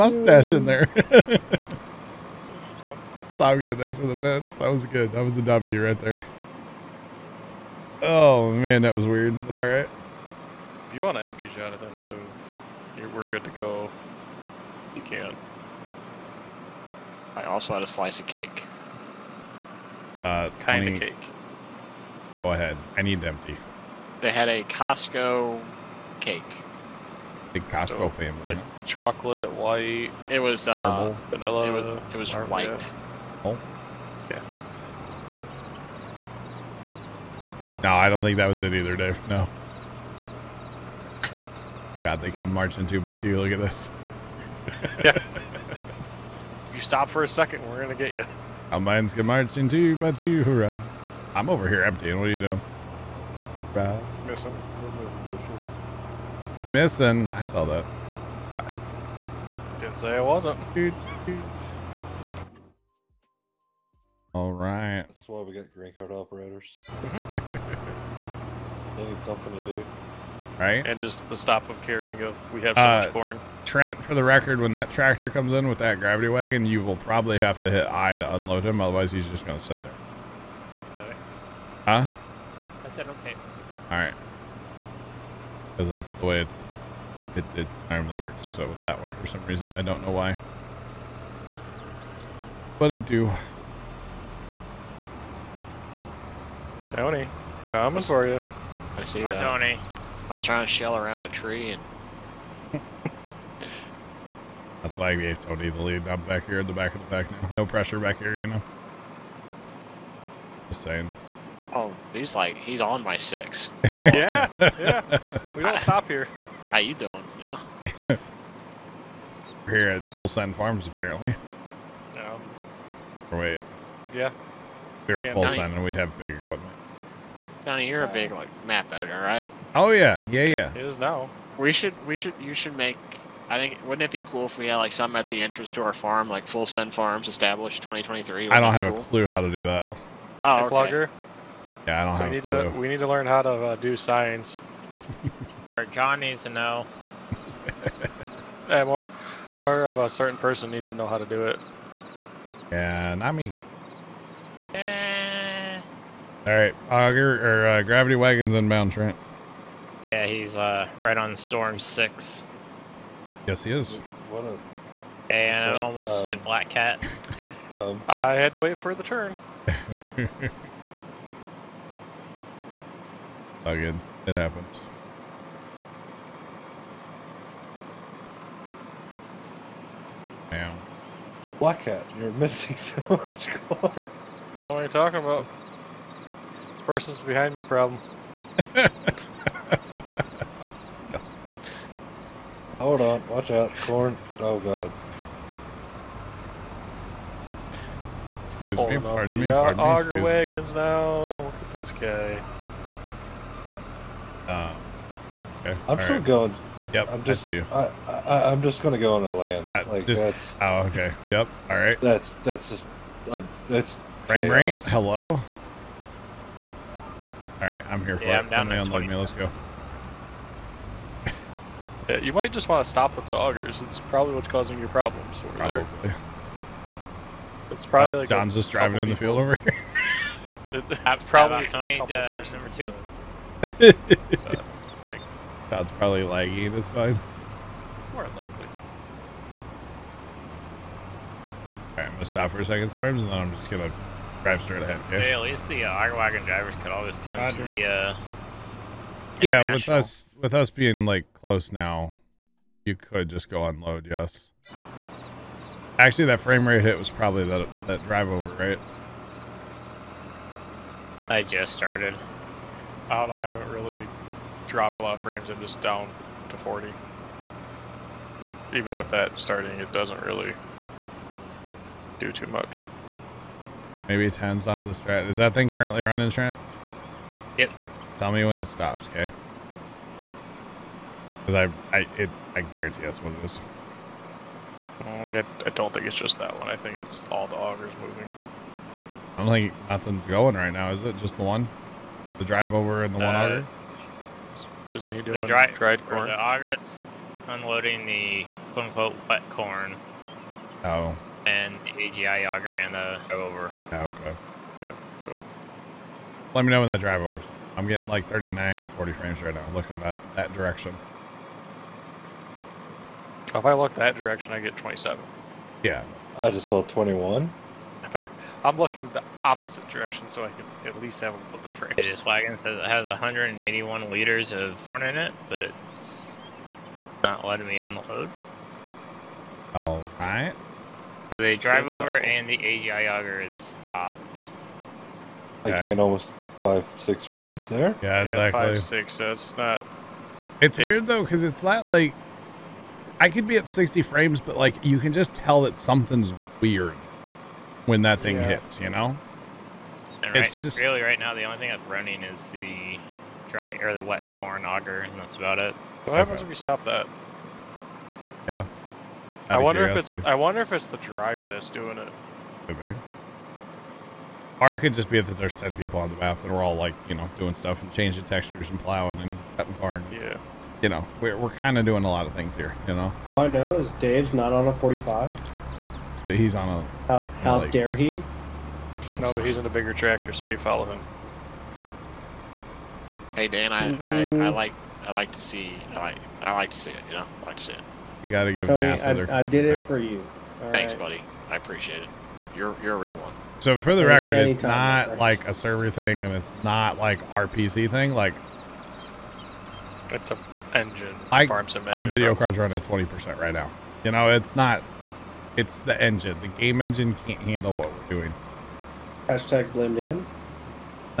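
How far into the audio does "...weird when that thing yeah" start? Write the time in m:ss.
5:46.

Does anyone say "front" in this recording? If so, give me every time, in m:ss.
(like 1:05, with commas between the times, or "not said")
5:24.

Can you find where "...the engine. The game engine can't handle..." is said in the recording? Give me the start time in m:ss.
6:45.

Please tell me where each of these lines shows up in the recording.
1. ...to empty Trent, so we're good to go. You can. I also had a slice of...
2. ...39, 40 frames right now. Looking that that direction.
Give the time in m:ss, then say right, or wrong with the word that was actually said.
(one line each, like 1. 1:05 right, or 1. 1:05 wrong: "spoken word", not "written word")
1. 0:11 wrong: "Jonathan", not "Trent"
2. 5:08 right.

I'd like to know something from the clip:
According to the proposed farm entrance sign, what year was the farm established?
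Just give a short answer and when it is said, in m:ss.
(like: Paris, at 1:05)
2023, at 2:17.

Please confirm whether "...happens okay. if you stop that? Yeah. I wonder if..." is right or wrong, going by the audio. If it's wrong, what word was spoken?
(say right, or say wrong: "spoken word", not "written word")
right.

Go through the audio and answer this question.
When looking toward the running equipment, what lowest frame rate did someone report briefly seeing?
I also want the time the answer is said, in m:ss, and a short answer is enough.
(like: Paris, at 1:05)
21, at 5:16.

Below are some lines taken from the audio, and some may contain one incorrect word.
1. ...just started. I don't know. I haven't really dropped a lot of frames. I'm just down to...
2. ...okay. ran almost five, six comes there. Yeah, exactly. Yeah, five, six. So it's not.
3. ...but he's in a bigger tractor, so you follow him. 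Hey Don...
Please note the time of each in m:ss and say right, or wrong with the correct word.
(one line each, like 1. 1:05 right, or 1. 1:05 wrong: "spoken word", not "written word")
1. 4:21 right
2. 5:35 wrong: "frames", not "comes"
3. 6:19 wrong: "Dan", not "Don".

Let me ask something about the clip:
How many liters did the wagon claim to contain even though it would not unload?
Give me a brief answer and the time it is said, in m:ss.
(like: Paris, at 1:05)
181, at 5:23.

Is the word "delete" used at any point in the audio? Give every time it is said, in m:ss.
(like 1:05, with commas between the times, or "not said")
not said.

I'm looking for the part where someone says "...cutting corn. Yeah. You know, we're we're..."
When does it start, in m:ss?
6:09.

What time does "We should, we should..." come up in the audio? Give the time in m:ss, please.
2:11.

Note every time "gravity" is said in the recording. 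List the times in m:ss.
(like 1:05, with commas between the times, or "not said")
1:15, 2:37.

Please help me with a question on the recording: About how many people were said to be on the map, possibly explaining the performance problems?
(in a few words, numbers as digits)
10.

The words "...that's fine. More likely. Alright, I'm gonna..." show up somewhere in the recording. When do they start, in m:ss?
3:56.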